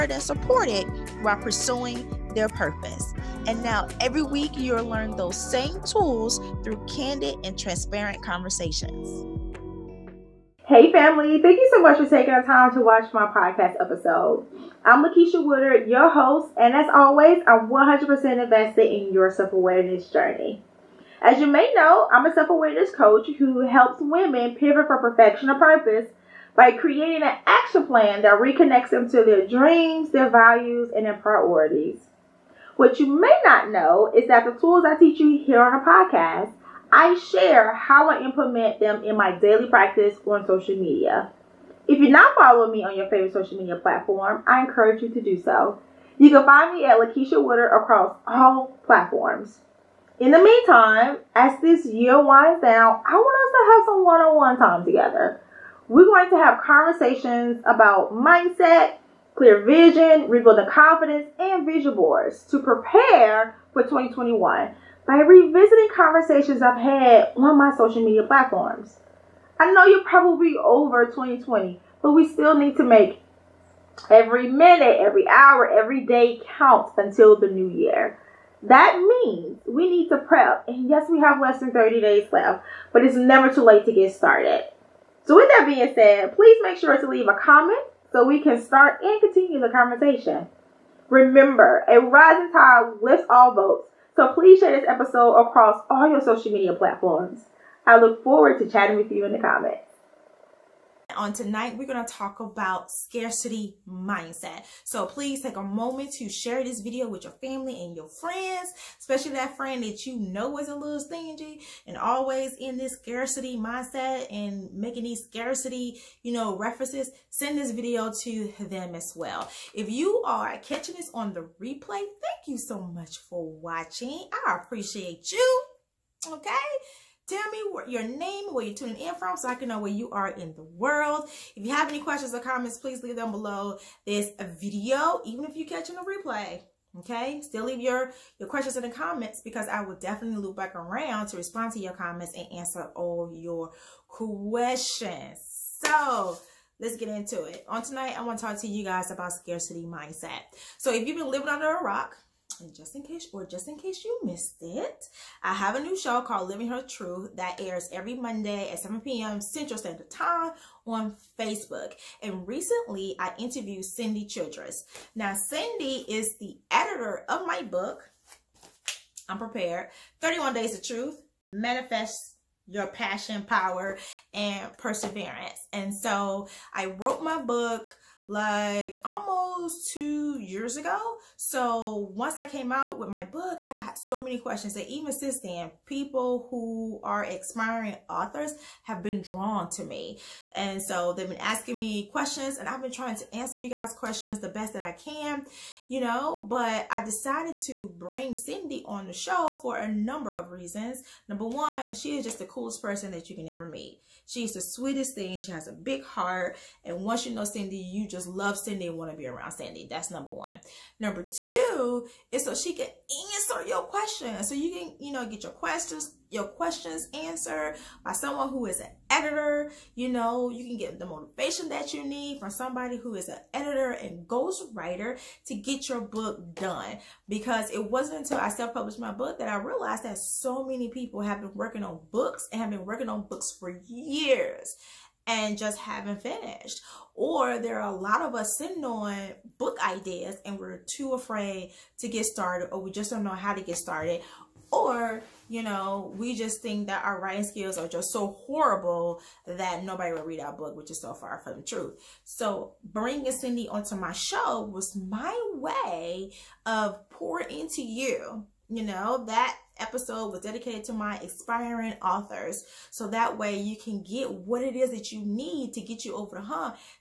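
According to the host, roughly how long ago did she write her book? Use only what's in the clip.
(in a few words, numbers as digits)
Almost two years.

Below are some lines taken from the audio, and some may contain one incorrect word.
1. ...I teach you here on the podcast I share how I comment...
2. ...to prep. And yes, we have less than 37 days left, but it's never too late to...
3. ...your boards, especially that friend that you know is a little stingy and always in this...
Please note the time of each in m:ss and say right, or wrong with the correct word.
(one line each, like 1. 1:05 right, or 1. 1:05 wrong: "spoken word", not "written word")
1. 0:34 wrong: "implement", not "comment"
2. 1:20 wrong: "30", not "37"
3. 1:47 wrong: "friends", not "boards".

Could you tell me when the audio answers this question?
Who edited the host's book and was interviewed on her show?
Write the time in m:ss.
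2:43.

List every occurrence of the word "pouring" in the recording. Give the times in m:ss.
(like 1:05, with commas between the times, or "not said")
4:17.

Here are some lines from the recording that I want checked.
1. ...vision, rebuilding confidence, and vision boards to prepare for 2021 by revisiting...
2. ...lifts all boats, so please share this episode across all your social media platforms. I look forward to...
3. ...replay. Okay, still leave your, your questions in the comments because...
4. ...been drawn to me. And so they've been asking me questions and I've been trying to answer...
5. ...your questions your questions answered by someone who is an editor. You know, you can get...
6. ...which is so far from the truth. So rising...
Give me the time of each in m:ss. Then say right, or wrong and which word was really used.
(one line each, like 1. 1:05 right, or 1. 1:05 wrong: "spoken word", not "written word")
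1. 0:59 right
2. 1:33 right
3. 2:16 right
4. 3:09 right
5. 3:35 right
6. 4:10 wrong: "bringing", not "rising".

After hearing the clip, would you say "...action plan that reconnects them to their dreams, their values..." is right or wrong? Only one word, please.
right.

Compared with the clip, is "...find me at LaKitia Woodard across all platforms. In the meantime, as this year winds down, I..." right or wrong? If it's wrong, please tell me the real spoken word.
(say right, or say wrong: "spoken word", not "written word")
right.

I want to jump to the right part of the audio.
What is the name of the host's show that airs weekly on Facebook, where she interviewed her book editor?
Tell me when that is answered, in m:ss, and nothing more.
2:36.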